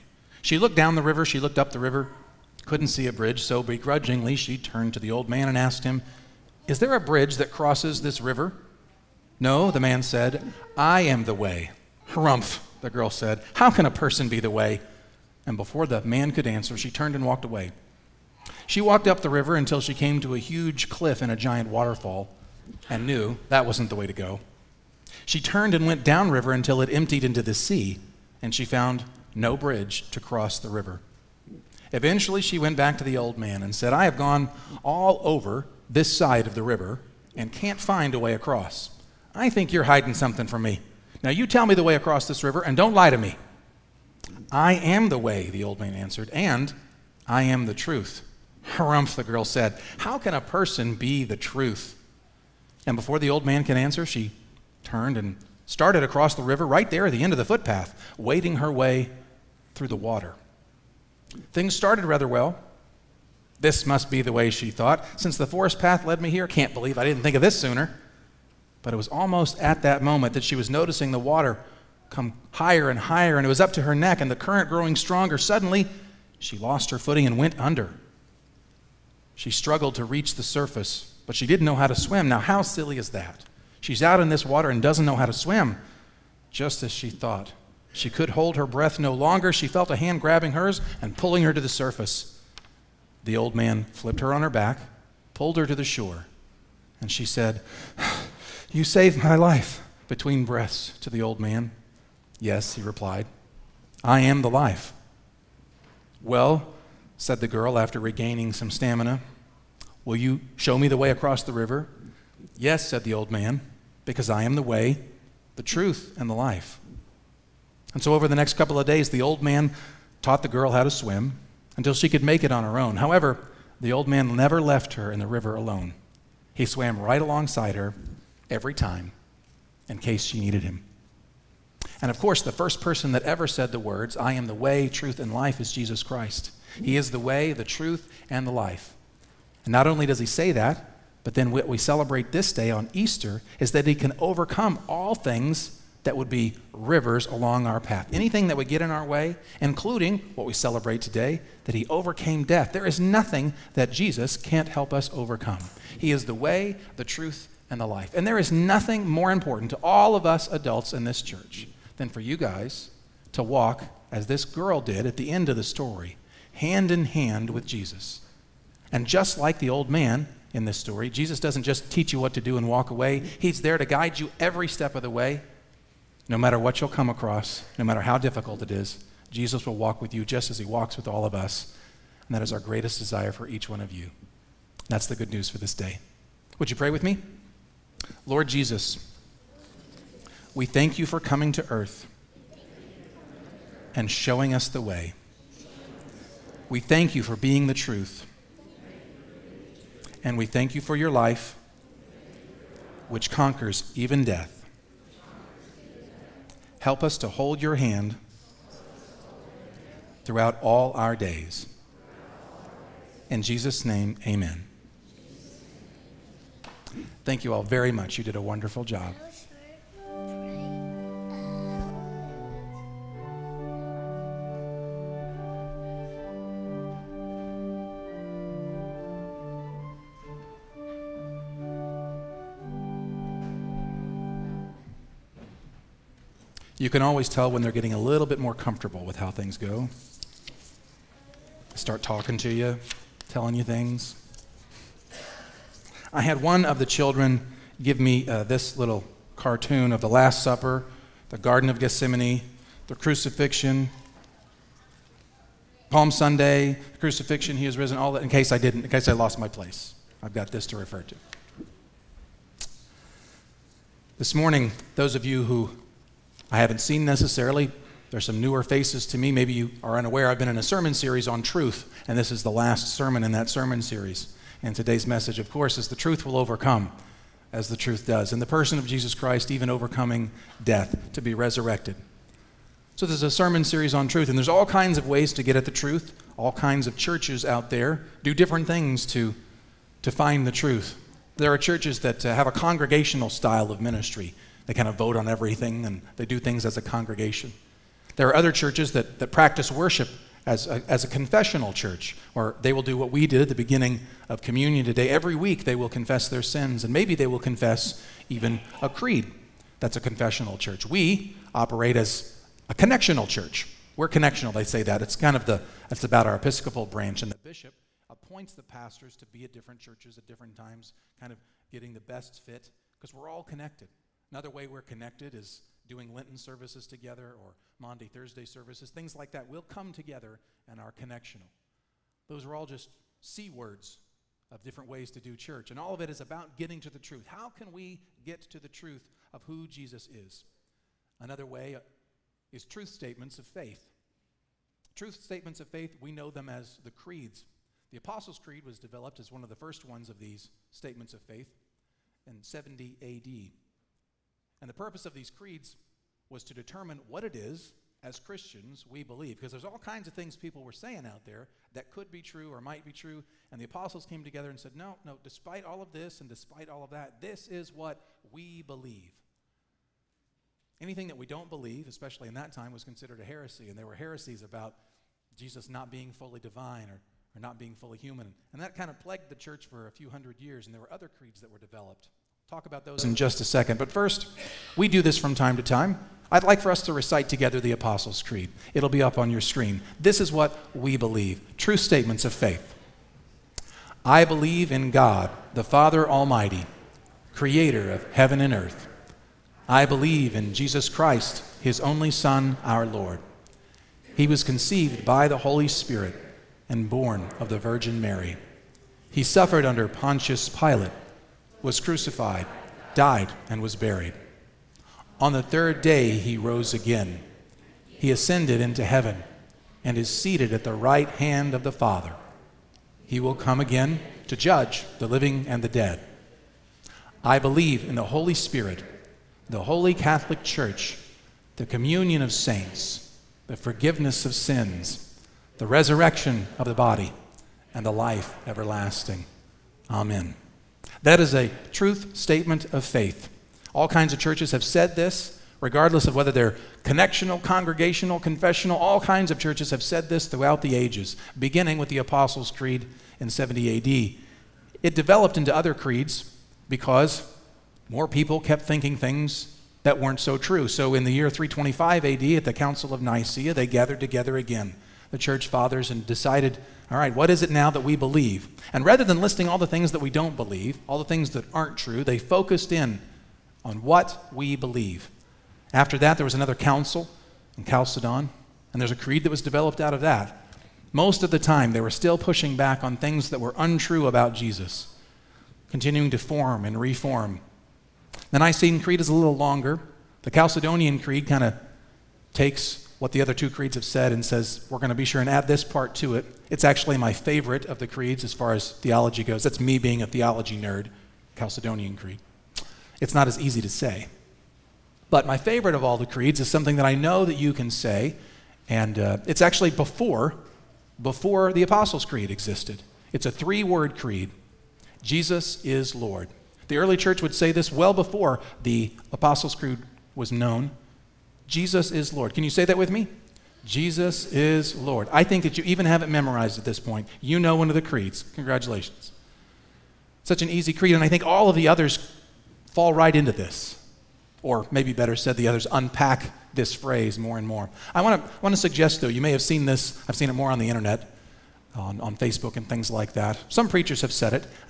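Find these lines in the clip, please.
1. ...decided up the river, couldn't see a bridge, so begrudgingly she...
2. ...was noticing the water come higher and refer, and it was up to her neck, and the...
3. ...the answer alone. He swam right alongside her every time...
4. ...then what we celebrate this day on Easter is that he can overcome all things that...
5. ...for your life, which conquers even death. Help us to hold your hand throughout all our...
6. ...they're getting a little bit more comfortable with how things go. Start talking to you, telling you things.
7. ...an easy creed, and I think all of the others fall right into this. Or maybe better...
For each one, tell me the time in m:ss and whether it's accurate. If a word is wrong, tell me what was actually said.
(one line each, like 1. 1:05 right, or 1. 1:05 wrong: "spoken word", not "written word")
1. 0:01 wrong: "looked", not "decided"
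2. 1:10 wrong: "higher", not "refer"
3. 2:05 wrong: "river", not "answer"
4. 2:21 right
5. 3:20 right
6. 3:57 right
7. 8:50 right.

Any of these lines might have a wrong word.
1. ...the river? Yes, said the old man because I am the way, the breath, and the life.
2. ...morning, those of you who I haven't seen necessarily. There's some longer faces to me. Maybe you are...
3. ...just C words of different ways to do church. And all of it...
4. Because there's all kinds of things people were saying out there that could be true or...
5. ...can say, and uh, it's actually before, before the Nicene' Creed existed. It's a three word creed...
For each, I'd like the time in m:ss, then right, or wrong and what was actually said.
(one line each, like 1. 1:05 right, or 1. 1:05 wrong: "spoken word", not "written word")
1. 1:51 wrong: "truth", not "breath"
2. 4:24 wrong: "newer", not "longer"
3. 5:32 right
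4. 5:59 right
5. 8:27 wrong: "Apostles", not "Nicene".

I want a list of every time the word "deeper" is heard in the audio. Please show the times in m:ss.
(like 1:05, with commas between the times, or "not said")
not said.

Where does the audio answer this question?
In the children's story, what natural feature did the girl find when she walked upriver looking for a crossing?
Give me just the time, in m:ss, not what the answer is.
0:21.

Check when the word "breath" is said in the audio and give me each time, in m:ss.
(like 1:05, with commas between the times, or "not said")
1:28, 1:40.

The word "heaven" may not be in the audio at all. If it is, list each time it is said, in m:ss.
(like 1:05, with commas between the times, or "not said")
6:38, 6:58.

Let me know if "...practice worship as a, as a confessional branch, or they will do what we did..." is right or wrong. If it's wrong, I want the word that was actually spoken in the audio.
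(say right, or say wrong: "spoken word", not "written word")
wrong: "church", not "branch".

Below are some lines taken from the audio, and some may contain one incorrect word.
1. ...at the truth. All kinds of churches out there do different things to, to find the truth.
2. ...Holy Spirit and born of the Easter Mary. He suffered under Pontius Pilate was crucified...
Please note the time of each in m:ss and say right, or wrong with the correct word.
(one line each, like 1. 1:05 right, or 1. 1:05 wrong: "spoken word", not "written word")
1. 4:45 right
2. 6:45 wrong: "Virgin", not "Easter".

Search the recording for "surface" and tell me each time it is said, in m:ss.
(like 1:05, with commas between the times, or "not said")
1:20, 1:31.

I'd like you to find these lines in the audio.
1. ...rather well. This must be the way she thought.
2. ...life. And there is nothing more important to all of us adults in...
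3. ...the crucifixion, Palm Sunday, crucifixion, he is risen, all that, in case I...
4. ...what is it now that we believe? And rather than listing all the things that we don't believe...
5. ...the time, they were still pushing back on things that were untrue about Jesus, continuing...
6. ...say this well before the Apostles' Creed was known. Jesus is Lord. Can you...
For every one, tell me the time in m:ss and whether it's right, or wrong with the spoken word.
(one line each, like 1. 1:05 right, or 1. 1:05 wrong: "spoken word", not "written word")
1. 1:02 right
2. 2:37 right
3. 4:12 right
4. 7:47 right
5. 8:01 right
6. 8:37 right.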